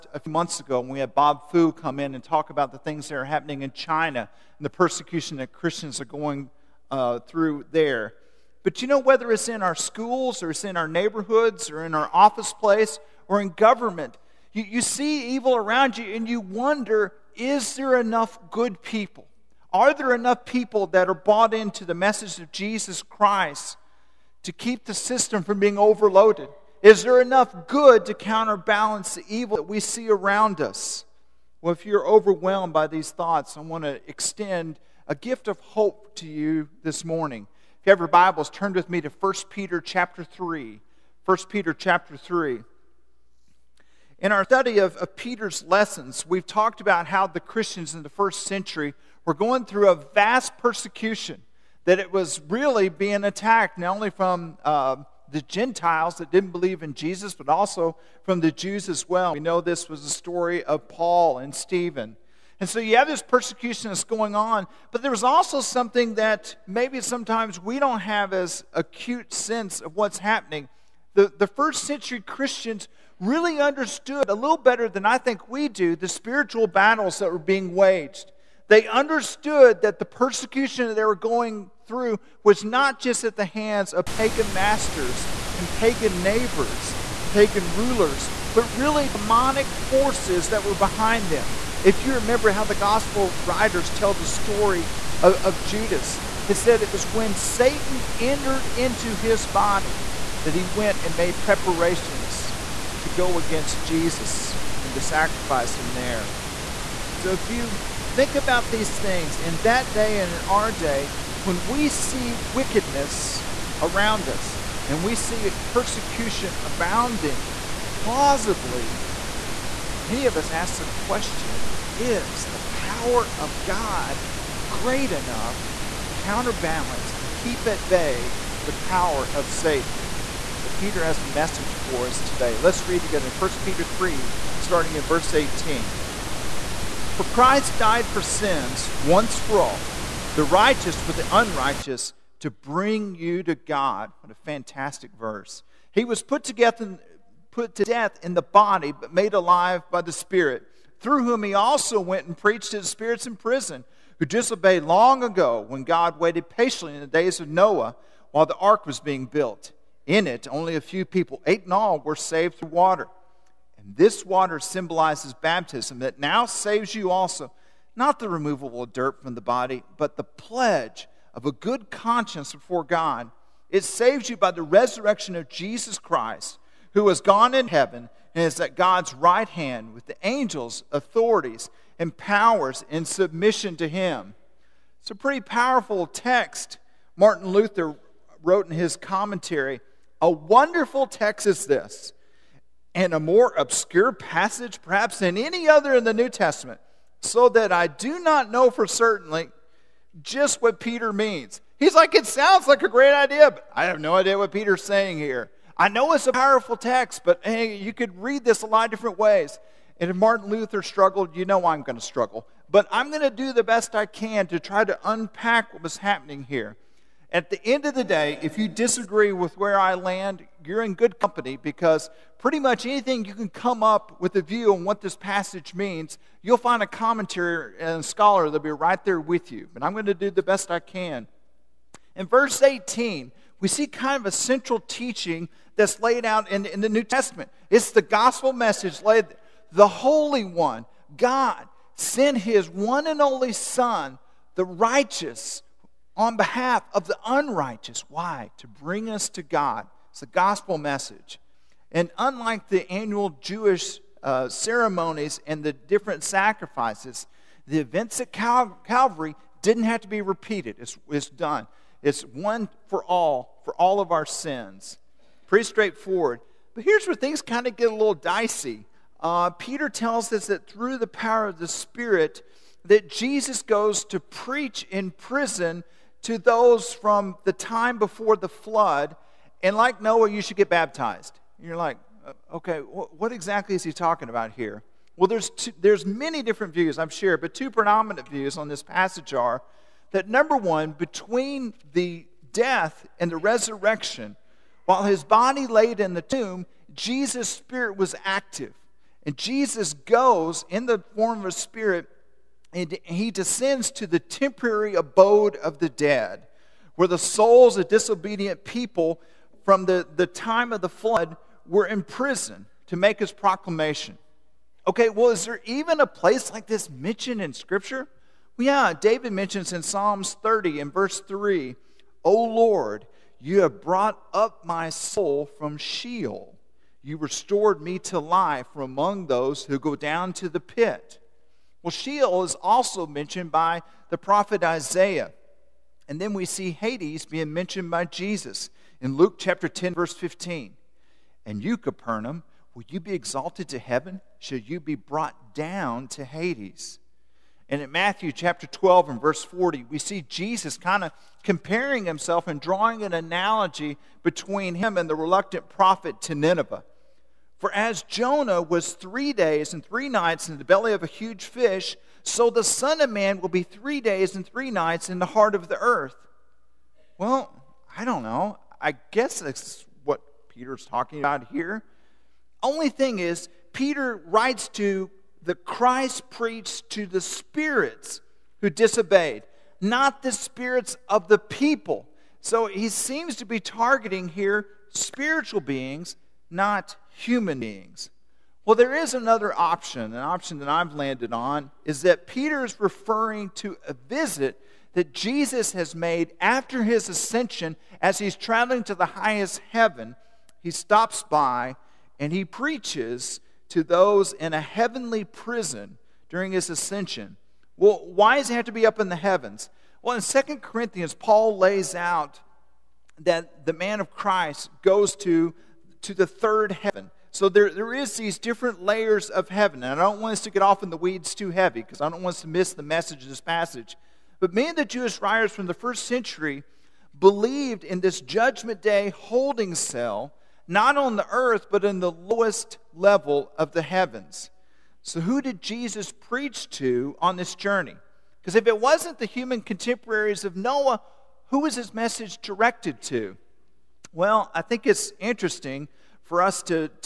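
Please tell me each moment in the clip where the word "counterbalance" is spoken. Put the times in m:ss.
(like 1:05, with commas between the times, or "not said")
0:28, 2:06.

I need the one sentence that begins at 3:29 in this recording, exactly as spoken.
And if Martin Luther struggled, you know I'm going to struggle.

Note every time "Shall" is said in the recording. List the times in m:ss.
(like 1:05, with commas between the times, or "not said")
5:44.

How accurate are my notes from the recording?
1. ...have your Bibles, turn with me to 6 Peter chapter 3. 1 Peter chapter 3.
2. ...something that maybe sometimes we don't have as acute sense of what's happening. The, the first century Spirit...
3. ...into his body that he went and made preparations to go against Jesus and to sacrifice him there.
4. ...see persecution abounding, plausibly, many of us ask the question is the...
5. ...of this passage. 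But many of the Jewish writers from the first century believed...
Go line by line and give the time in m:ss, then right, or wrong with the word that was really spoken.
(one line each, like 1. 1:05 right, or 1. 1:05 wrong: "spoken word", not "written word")
1. 0:37 wrong: "1", not "6"
2. 1:05 wrong: "Christians", not "Spirit"
3. 1:38 right
4. 1:55 right
5. 7:03 right.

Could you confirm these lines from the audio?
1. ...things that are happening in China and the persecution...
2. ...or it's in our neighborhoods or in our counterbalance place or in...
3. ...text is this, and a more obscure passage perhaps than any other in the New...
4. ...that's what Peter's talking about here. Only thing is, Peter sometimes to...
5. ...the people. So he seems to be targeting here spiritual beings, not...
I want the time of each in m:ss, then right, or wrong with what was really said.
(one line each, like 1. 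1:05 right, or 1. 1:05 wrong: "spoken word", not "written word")
1. 0:02 right
2. 0:10 wrong: "office", not "counterbalance"
3. 3:11 right
4. 6:09 wrong: "writes", not "sometimes"
5. 6:21 right.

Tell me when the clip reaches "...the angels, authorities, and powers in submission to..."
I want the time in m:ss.
3:00.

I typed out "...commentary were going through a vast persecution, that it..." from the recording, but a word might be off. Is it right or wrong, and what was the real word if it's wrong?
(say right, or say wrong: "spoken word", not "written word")
wrong: "century", not "commentary".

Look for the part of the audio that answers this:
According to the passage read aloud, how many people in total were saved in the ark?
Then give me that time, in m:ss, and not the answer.
2:41.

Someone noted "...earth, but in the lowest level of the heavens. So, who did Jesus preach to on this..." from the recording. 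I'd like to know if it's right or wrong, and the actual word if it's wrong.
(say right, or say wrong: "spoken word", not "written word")
right.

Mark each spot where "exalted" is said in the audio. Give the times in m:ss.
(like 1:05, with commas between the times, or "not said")
5:43.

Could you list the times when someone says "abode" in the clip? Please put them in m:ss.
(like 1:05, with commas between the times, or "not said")
5:04.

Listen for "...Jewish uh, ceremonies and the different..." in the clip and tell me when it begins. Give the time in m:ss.
4:13.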